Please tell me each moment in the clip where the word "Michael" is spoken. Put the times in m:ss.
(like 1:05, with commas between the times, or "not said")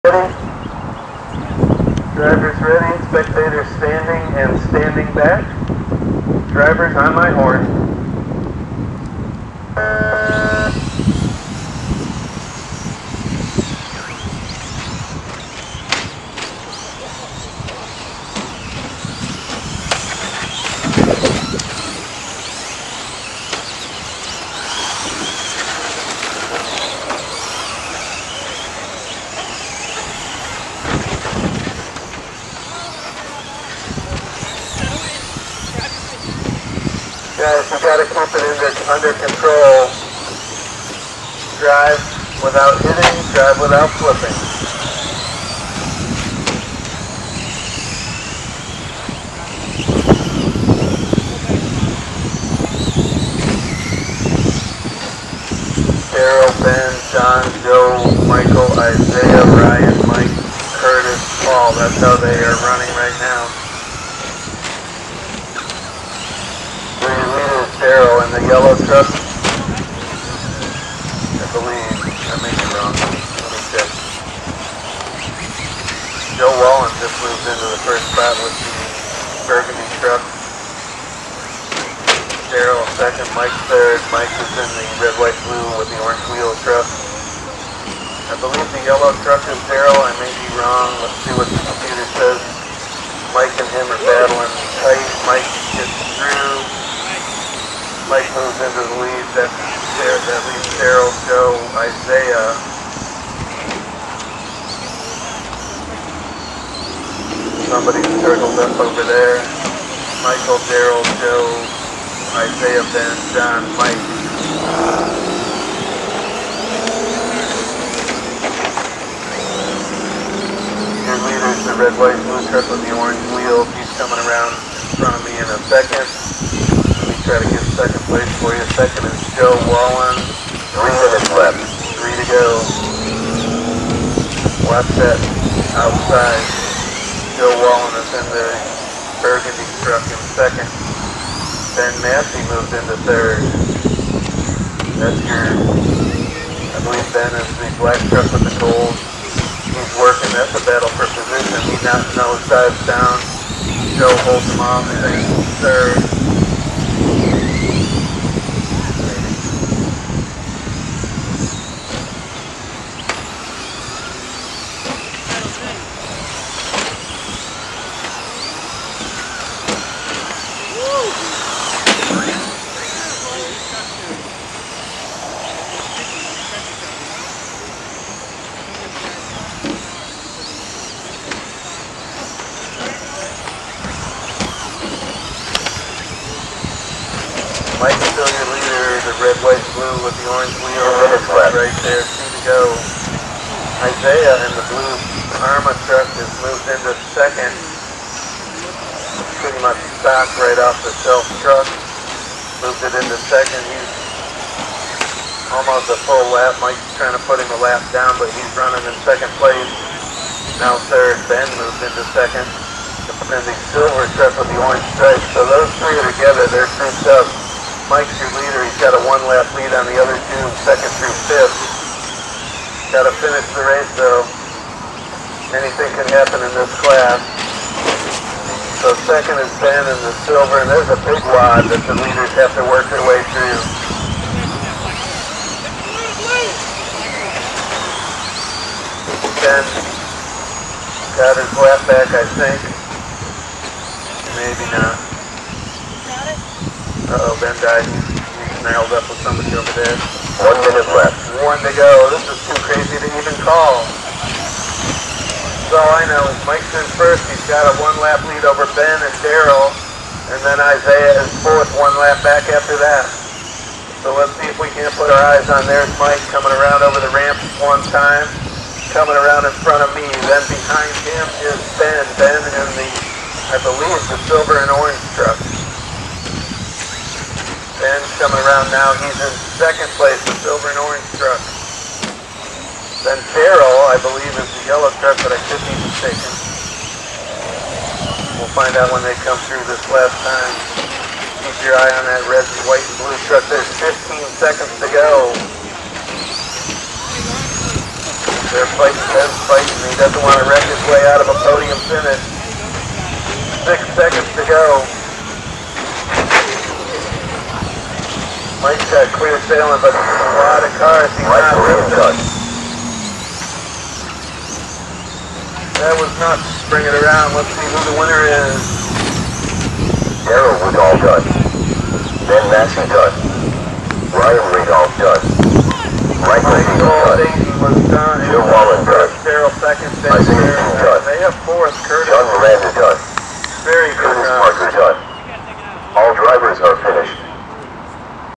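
0:58, 1:50, 5:26.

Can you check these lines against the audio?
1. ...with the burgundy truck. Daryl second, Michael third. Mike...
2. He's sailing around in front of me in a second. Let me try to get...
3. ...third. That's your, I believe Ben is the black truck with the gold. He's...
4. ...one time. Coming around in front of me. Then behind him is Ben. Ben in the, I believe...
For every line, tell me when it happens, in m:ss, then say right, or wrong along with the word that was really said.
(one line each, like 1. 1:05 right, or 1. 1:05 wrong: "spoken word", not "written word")
1. 1:18 wrong: "Mike", not "Michael"
2. 2:03 wrong: "coming", not "sailing"
3. 2:23 right
4. 4:27 right.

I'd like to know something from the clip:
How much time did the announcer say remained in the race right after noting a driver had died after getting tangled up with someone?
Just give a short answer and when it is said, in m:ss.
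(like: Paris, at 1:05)
1 minute, at 4:10.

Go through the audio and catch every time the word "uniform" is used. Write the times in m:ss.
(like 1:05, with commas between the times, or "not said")
not said.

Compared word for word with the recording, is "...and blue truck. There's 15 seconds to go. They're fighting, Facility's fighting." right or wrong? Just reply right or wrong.
wrong.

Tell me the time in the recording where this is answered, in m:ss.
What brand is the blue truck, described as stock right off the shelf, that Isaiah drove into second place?
3:14.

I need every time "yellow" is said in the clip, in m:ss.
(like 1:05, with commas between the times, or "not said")
1:08, 1:28, 4:44.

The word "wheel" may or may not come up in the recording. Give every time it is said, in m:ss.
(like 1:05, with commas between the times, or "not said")
1:26, 2:03, 3:10.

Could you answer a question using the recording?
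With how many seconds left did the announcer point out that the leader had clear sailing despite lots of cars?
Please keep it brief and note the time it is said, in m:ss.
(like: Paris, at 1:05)
6, at 5:03.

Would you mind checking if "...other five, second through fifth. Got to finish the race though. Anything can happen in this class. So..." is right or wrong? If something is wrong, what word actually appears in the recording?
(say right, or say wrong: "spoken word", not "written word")
wrong: "two", not "five".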